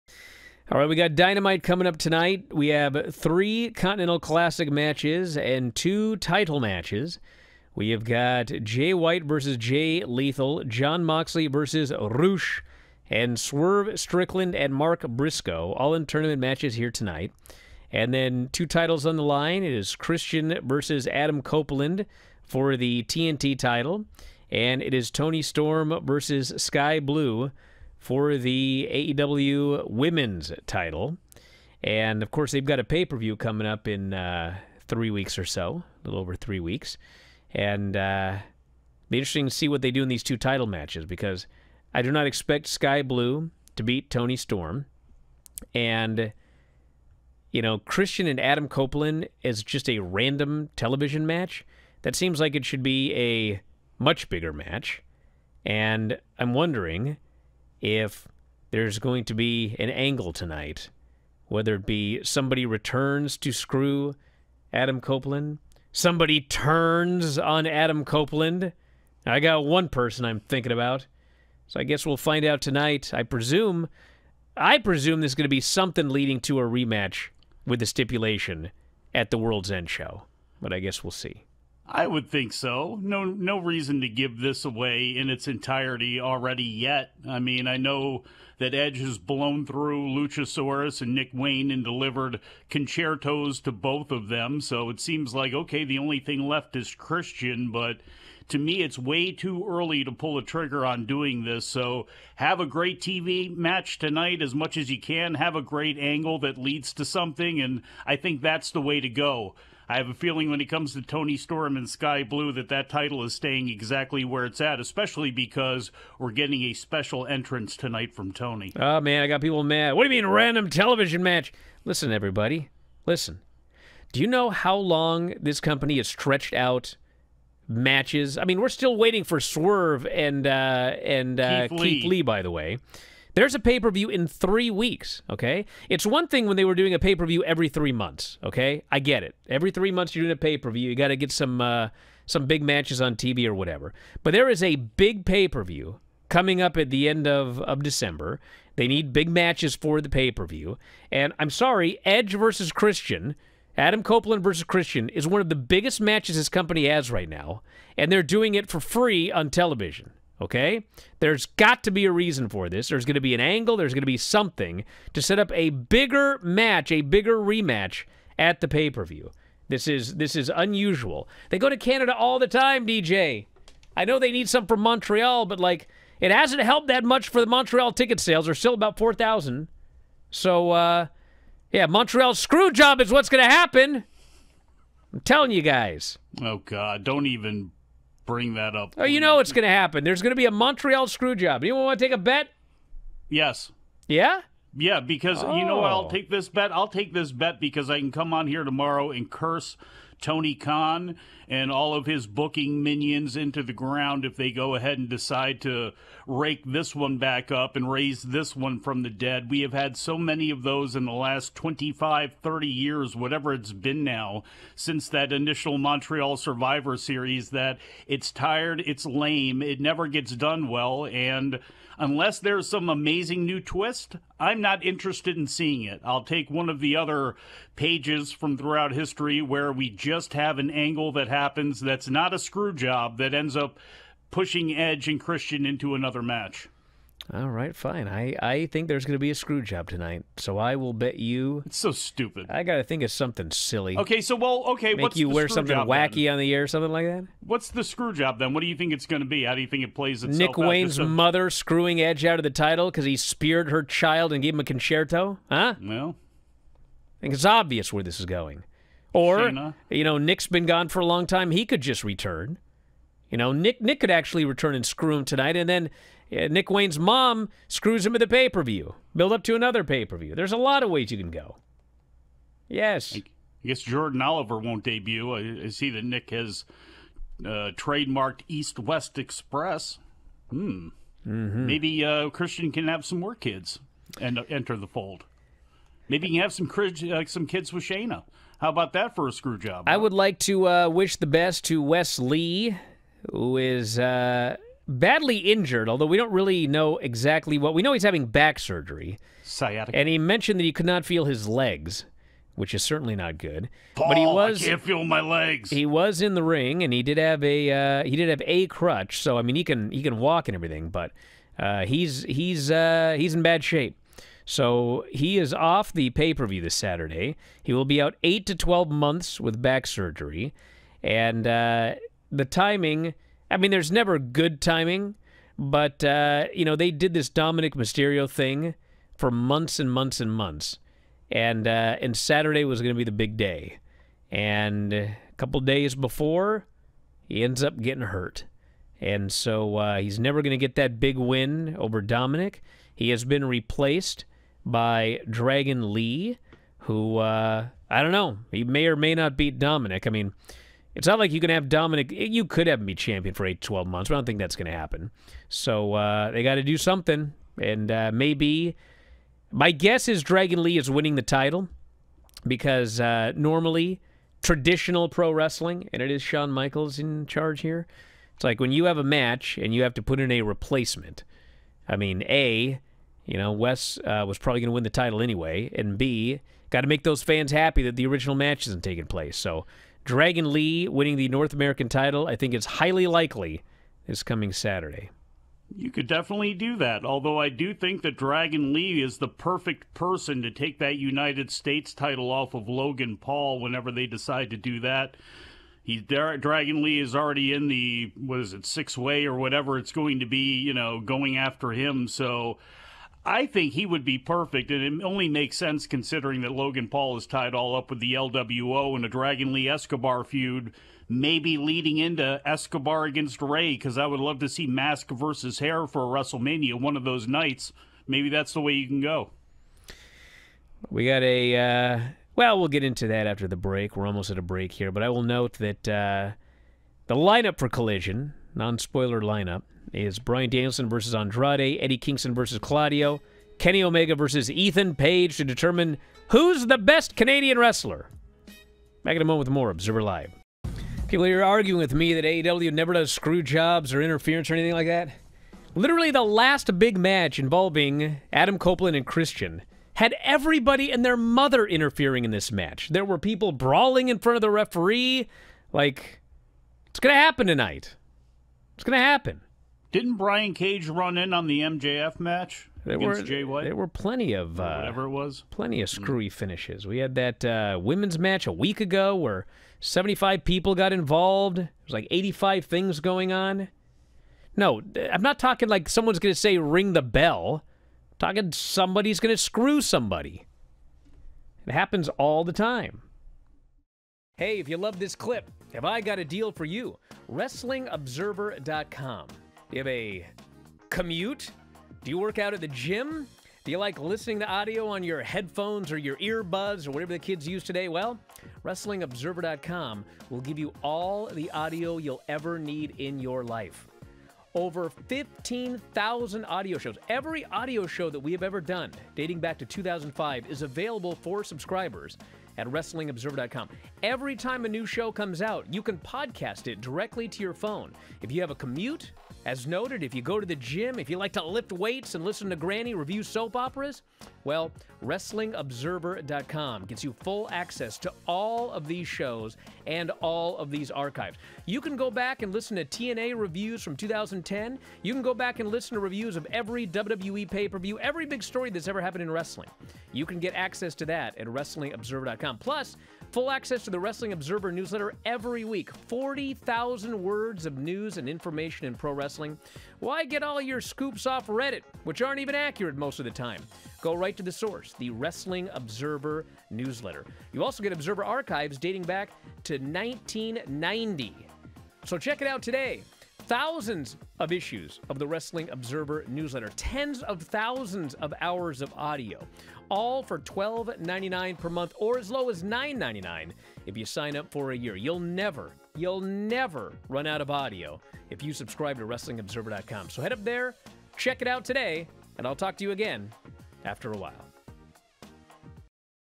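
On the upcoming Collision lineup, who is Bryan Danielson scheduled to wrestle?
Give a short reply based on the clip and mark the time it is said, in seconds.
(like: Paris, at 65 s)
Andrade, at 431 s.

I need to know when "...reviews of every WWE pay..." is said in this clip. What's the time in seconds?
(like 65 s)
535 s.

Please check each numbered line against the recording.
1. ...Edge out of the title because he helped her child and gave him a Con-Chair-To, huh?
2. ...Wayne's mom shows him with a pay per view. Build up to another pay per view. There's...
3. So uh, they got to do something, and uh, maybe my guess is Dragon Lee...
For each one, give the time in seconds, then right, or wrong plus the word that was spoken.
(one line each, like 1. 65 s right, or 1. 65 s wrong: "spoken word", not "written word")
1. 252 s wrong: "speared", not "helped"
2. 266 s wrong: "screws", not "shows"
3. 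355 s right.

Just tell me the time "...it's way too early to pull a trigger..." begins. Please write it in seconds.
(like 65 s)
98 s.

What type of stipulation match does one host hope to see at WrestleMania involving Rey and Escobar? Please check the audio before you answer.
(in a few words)
Mask versus Hair.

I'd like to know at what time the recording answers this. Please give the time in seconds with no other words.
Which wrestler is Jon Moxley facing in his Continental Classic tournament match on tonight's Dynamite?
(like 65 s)
11 s.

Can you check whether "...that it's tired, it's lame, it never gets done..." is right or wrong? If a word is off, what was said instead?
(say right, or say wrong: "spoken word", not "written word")
right.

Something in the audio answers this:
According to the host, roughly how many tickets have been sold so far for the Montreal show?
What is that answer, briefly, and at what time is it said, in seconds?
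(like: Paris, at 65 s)
4,000, at 178 s.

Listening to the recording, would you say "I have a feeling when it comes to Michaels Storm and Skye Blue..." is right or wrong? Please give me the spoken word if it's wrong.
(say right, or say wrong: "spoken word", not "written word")
wrong: "Toni", not "Michaels".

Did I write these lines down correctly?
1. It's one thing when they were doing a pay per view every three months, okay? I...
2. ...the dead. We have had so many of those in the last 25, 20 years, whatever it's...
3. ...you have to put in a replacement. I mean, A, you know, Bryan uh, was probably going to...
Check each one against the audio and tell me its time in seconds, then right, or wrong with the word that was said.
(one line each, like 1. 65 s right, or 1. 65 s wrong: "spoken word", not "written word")
1. 135 s right
2. 209 s wrong: "30", not "20"
3. 369 s wrong: "Wes", not "Bryan".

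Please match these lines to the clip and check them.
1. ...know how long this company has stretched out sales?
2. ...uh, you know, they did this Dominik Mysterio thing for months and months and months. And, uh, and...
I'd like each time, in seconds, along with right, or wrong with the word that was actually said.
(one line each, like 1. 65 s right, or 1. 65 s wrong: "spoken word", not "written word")
1. 124 s wrong: "matches", not "sales"
2. 326 s right.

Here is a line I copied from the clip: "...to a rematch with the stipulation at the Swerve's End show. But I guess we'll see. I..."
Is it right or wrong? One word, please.
wrong.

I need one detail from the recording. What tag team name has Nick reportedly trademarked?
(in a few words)
East West Express.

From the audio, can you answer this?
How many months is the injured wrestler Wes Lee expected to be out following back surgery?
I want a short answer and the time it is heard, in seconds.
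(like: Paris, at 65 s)
8 to 12 months, at 318 s.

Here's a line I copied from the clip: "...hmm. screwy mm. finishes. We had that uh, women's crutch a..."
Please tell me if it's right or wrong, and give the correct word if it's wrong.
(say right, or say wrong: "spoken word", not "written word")
wrong: "match", not "crutch".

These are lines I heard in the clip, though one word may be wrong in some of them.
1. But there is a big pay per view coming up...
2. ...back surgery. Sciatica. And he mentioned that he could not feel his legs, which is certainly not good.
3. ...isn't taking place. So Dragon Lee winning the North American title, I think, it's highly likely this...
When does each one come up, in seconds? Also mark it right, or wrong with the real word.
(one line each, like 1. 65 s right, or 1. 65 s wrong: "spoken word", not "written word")
1. 144 s right
2. 298 s right
3. 378 s right.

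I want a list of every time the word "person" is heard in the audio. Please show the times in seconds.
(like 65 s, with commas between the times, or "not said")
69 s, 389 s.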